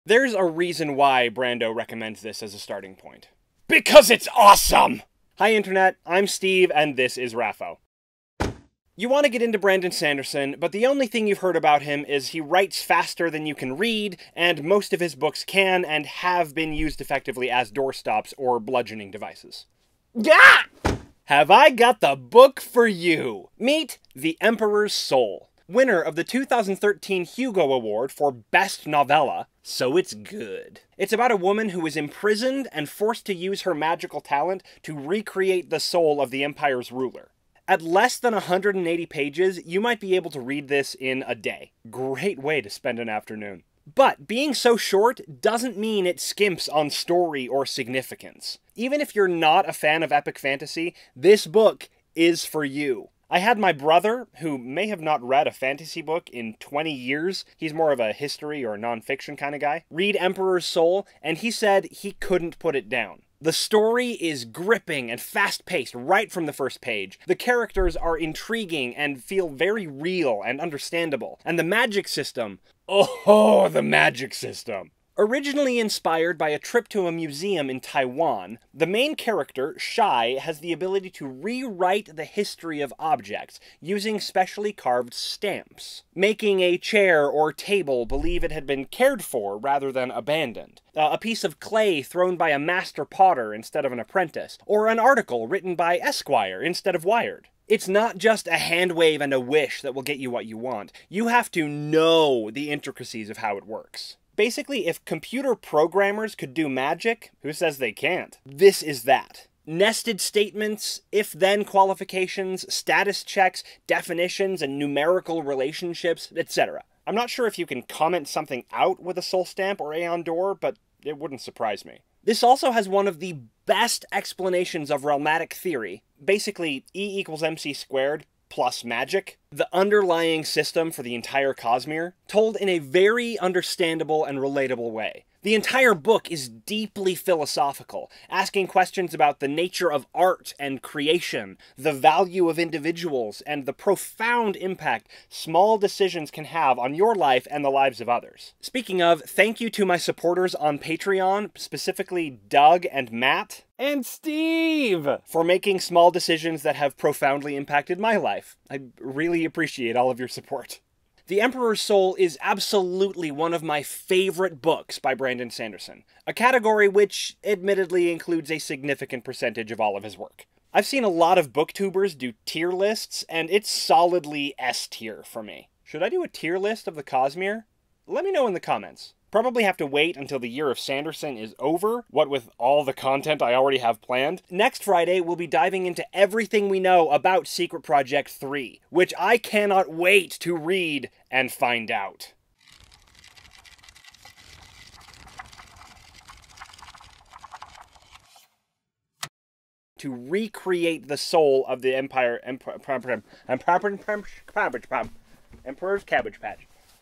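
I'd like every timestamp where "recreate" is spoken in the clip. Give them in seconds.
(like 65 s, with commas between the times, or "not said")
34 s, 200 s.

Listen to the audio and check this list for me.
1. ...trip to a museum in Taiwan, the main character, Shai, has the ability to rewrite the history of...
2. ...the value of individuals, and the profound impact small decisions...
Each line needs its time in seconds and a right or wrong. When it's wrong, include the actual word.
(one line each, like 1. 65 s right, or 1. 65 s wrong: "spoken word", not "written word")
1. 76 s right
2. 141 s right.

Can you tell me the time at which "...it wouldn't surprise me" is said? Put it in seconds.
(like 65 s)
121 s.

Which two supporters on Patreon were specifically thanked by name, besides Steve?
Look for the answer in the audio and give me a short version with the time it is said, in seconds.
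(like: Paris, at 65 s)
Doug and Matt, at 152 s.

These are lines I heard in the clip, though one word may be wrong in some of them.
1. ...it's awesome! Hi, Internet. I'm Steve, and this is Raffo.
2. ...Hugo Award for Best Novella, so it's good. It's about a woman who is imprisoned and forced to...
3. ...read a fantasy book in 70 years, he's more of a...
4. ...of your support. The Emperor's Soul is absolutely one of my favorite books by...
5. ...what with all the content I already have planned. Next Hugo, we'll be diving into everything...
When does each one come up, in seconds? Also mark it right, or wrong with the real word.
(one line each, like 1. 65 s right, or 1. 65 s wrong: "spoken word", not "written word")
1. 4 s right
2. 27 s right
3. 55 s wrong: "20", not "70"
4. 160 s right
5. 182 s wrong: "Friday", not "Hugo".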